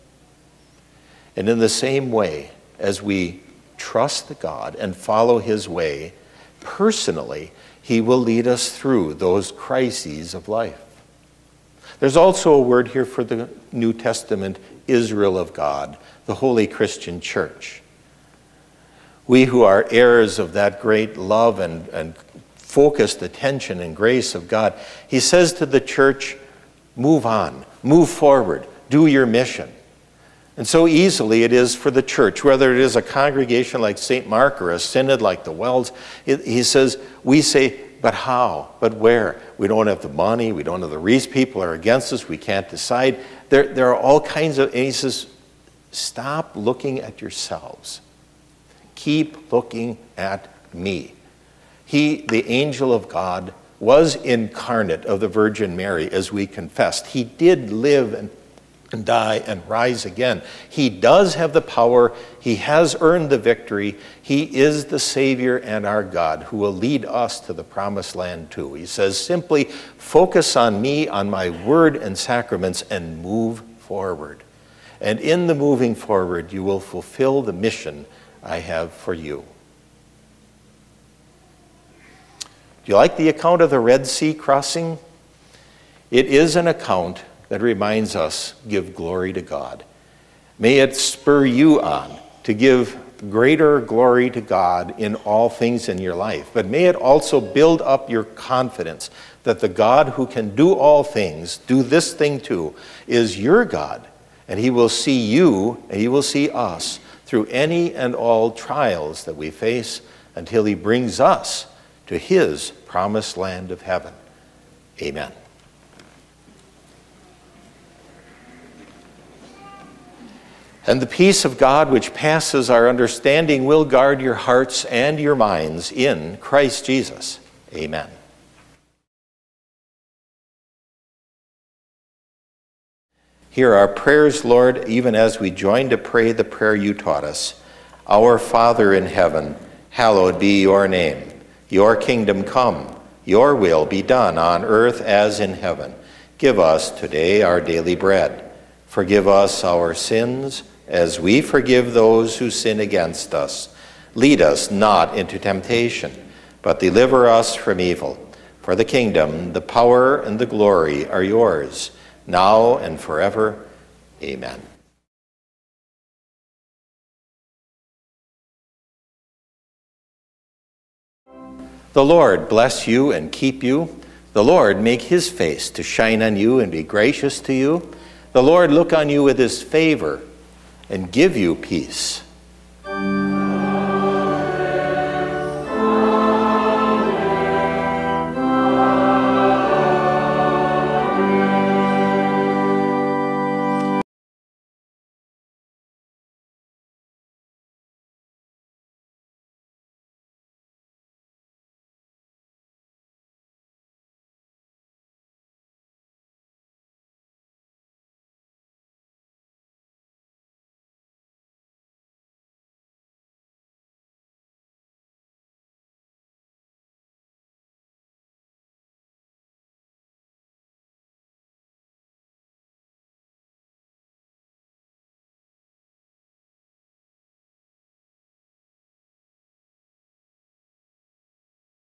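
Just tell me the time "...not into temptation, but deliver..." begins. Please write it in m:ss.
2:34.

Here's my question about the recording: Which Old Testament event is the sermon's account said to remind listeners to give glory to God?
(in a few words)
Red Sea crossing.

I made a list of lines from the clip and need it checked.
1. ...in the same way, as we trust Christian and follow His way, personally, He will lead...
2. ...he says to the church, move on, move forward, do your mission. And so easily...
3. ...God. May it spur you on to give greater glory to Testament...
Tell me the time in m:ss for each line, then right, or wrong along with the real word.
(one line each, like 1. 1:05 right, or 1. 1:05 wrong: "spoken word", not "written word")
1. 0:01 wrong: "God", not "Christian"
2. 0:25 right
3. 1:29 wrong: "God", not "Testament".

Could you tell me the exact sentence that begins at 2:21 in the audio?
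Your kingdom come, your will be done on earth as in heaven.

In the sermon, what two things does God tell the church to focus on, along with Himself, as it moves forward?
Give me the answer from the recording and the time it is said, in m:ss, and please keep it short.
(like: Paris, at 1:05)
Word and sacraments, at 1:11.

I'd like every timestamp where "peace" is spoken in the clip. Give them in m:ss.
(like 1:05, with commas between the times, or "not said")
2:01, 3:01.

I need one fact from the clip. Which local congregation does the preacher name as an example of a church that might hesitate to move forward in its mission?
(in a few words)
St. Mark.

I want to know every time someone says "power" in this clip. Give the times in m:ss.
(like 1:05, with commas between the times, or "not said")
1:01, 2:39.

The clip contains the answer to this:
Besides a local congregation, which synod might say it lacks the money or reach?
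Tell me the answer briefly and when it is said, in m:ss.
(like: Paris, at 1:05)
WELS, at 0:35.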